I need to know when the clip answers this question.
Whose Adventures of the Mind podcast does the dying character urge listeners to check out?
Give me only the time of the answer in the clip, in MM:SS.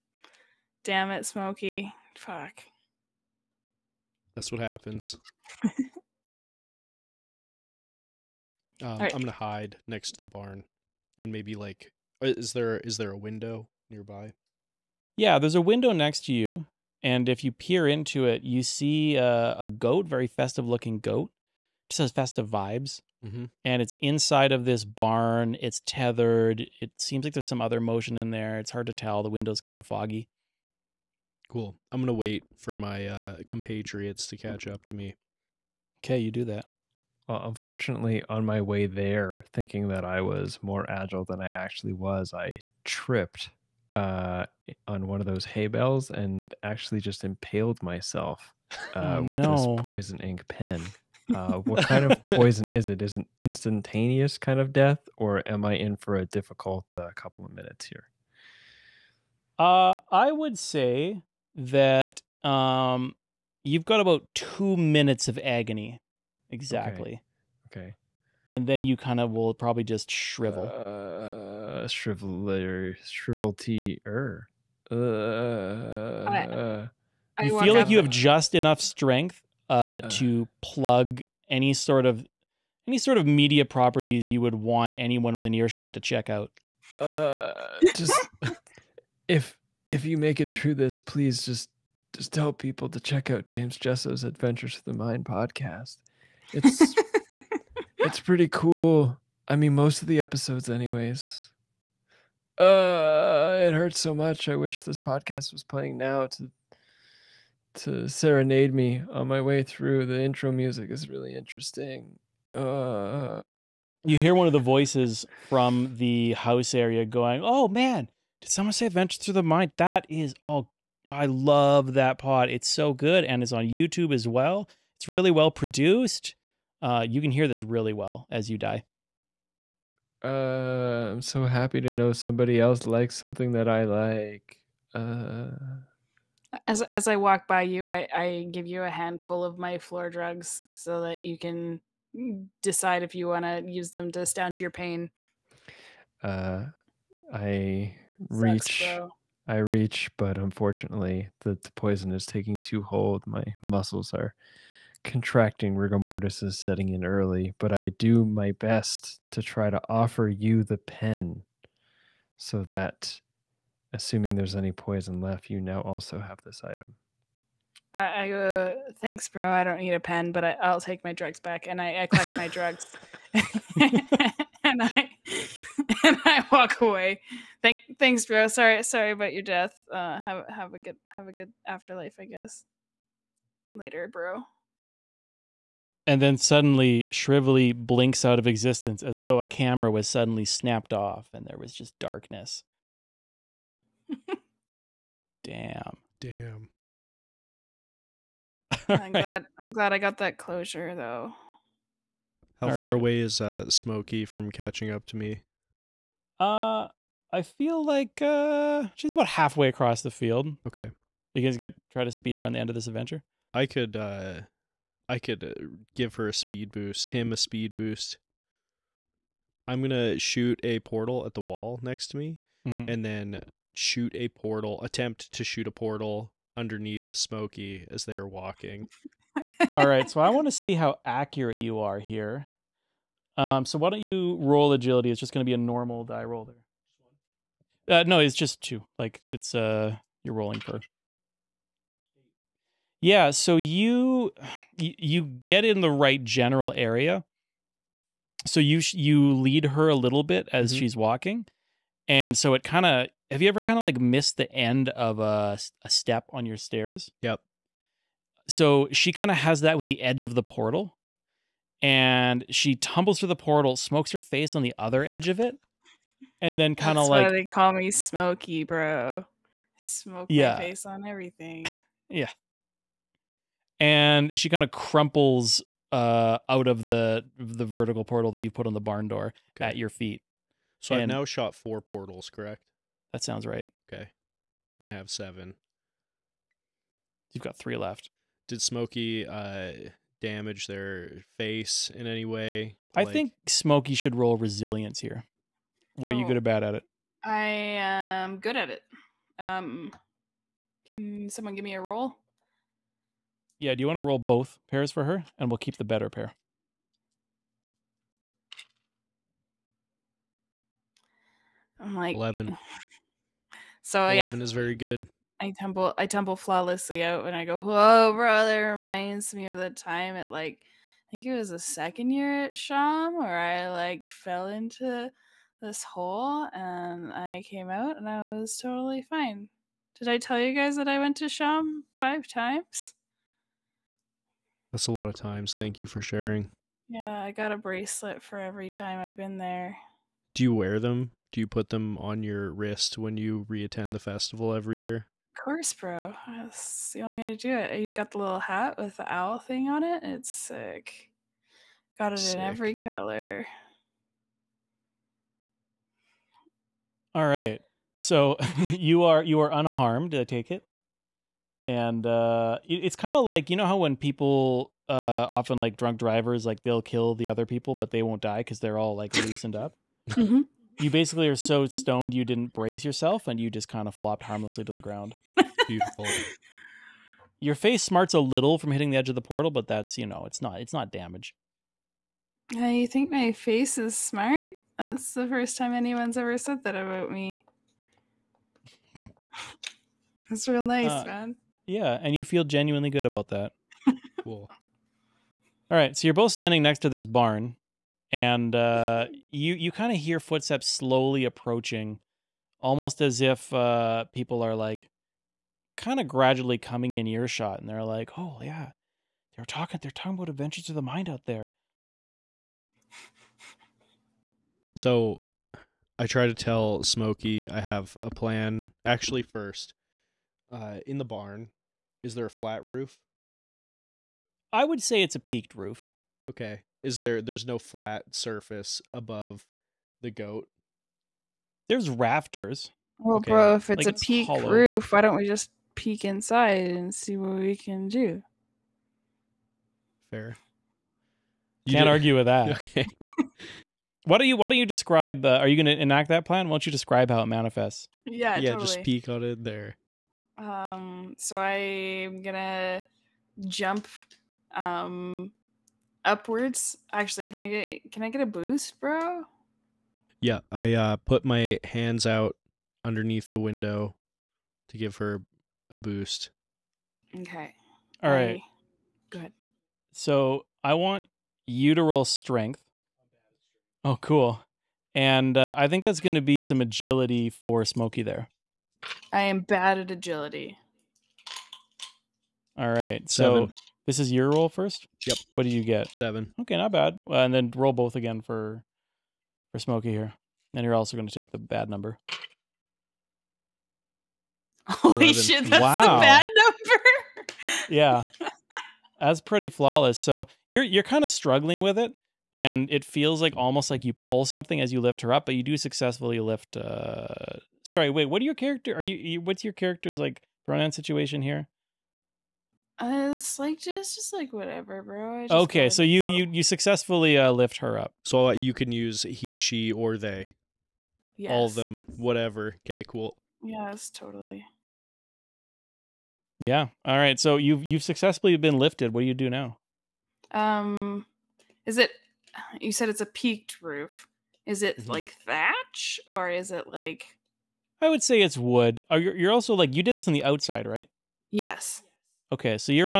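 01:33.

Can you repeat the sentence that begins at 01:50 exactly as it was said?
The intro music is really interesting.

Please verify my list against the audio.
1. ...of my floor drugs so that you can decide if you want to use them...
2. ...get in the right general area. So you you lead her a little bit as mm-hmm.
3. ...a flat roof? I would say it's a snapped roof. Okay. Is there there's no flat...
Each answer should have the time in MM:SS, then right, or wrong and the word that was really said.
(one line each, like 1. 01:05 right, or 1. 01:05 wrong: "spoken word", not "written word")
1. 02:19 right
2. 04:05 right
3. 07:02 wrong: "peaked", not "snapped".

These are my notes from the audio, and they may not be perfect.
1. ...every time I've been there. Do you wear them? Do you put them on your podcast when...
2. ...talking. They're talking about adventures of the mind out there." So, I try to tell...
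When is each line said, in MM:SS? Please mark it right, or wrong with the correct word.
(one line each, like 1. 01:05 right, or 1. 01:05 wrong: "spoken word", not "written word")
1. 05:38 wrong: "wrist", not "podcast"
2. 06:49 right.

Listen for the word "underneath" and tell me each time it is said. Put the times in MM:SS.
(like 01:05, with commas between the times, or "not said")
03:46, 07:42.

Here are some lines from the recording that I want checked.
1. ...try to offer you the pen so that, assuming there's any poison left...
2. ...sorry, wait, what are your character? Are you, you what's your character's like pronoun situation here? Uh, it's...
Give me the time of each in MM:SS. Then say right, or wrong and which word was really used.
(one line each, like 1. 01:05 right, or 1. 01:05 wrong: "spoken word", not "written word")
1. 02:39 right
2. 08:27 right.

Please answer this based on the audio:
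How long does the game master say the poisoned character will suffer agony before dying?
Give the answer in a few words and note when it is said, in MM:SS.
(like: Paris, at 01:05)
2 minutes, at 01:04.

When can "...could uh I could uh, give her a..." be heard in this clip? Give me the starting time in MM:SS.
03:33.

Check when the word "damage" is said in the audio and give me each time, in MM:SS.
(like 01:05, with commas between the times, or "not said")
04:50, 06:20.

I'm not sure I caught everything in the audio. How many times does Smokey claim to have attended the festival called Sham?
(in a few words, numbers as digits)
5.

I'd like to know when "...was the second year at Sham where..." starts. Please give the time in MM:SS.
05:21.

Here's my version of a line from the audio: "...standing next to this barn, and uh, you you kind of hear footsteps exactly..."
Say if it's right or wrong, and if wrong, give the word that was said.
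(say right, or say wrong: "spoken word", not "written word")
wrong: "slowly", not "exactly".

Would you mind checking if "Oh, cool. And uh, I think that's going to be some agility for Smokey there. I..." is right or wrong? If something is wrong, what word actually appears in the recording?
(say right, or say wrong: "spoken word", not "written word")
right.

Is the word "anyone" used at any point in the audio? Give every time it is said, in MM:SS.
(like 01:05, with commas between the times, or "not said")
01:24, 06:25.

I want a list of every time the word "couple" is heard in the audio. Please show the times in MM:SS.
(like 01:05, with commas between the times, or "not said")
00:57.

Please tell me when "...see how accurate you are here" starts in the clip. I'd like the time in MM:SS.
03:50.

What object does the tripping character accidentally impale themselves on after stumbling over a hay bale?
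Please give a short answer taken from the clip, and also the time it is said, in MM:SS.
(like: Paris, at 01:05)
poison ink pen, at 00:49.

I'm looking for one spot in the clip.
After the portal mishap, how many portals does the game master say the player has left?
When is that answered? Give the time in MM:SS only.
04:47.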